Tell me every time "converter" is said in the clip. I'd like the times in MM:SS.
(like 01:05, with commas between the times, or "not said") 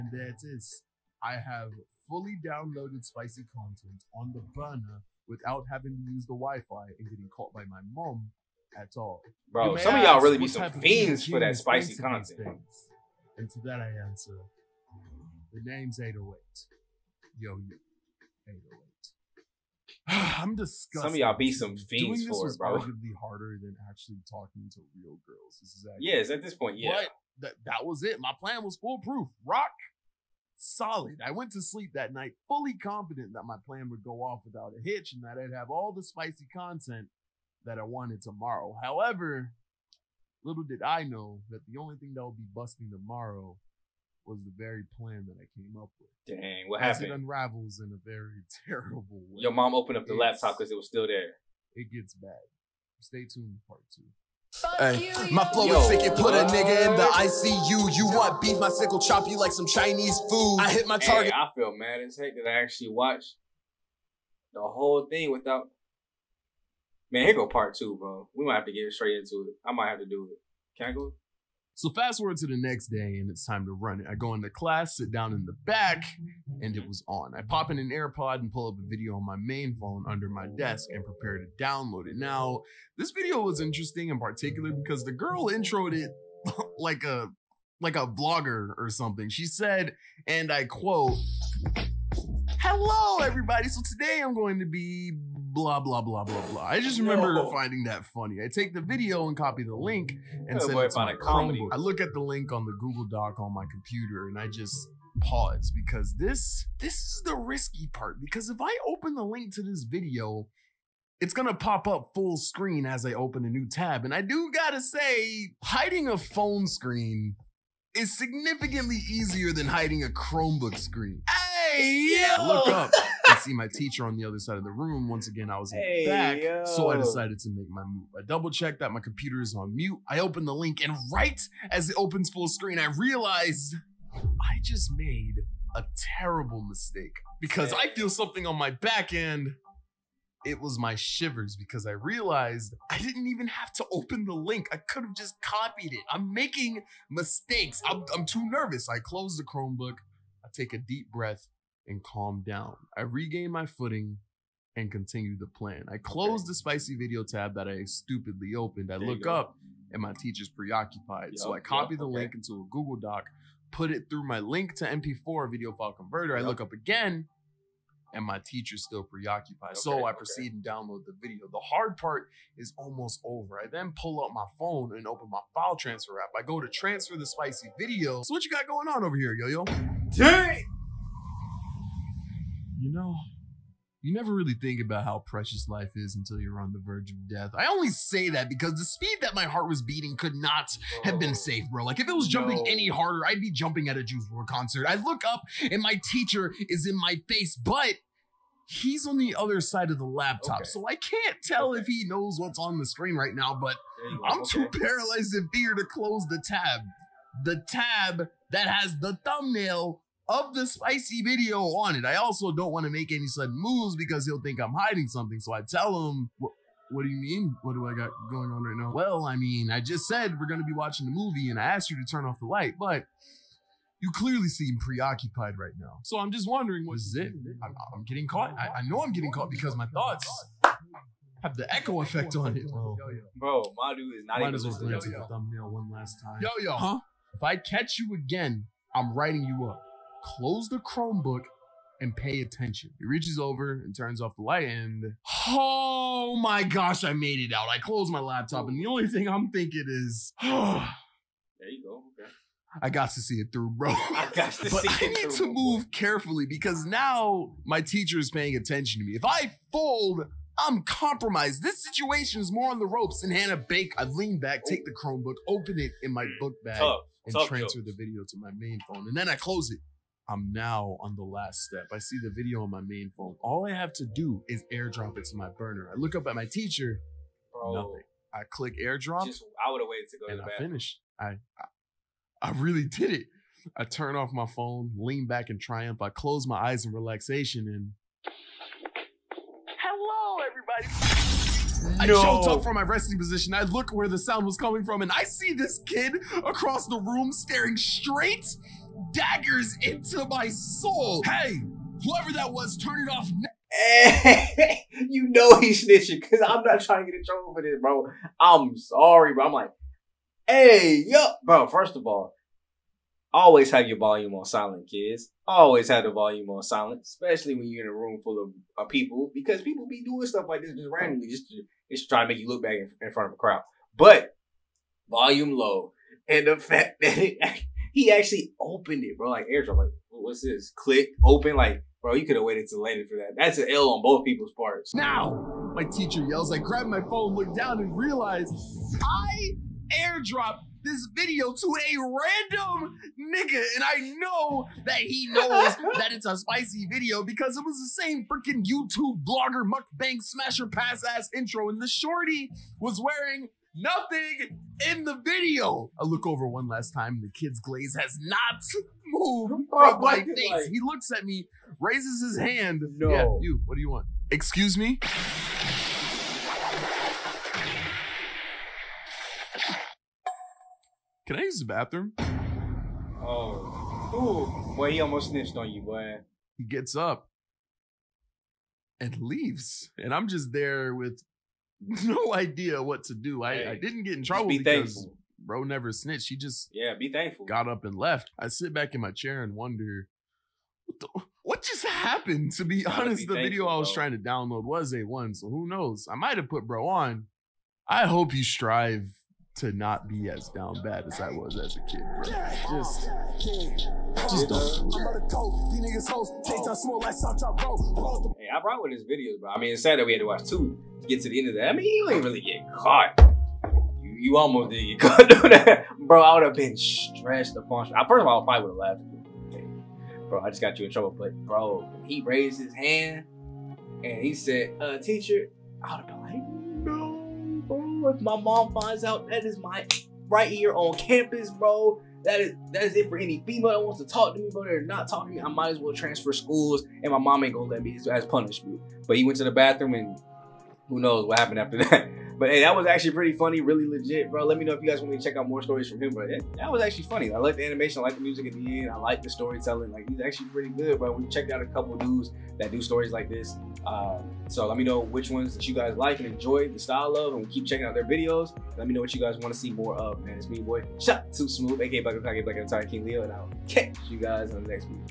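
02:45.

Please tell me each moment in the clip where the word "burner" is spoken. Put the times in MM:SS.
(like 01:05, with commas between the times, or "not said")
00:04, 04:35.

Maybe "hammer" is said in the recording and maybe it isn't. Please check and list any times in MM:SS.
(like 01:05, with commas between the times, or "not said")
not said.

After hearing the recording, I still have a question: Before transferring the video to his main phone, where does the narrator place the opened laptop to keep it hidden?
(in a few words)
Book bag.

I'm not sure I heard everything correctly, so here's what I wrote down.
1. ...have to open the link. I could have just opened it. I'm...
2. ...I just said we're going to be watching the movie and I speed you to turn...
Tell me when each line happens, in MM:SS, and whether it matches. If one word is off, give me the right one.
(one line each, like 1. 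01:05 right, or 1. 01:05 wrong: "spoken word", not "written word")
1. 02:23 wrong: "copied", not "opened"
2. 03:39 wrong: "asked", not "speed".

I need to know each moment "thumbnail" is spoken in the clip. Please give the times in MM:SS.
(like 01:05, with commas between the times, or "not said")
03:29, 03:55.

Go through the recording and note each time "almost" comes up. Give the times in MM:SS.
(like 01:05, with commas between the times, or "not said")
02:52, 06:15, 06:54.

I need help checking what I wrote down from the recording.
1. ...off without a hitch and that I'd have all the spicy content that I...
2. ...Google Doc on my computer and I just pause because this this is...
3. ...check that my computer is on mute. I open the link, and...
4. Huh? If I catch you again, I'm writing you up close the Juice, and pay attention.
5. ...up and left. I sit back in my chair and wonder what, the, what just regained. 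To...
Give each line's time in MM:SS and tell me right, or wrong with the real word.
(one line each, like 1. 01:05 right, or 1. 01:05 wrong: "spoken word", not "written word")
1. 00:34 right
2. 01:42 right
3. 02:08 right
4. 03:56 wrong: "Chromebook", not "Juice"
5. 06:27 wrong: "happened", not "regained".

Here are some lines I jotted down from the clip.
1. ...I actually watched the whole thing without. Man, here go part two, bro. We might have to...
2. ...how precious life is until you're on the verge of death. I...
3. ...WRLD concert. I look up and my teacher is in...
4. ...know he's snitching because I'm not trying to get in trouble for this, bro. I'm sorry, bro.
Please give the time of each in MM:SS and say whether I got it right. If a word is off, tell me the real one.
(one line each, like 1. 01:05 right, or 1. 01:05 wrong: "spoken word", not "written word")
1. 01:02 right
2. 03:05 right
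3. 03:14 right
4. 05:05 right.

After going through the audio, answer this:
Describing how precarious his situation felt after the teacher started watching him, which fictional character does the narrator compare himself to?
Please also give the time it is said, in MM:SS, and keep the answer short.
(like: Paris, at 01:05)
Hannah Baker, at 04:23.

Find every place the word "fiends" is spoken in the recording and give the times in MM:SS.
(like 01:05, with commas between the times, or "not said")
00:10, 00:21.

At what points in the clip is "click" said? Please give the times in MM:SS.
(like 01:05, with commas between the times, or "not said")
04:38, 05:30.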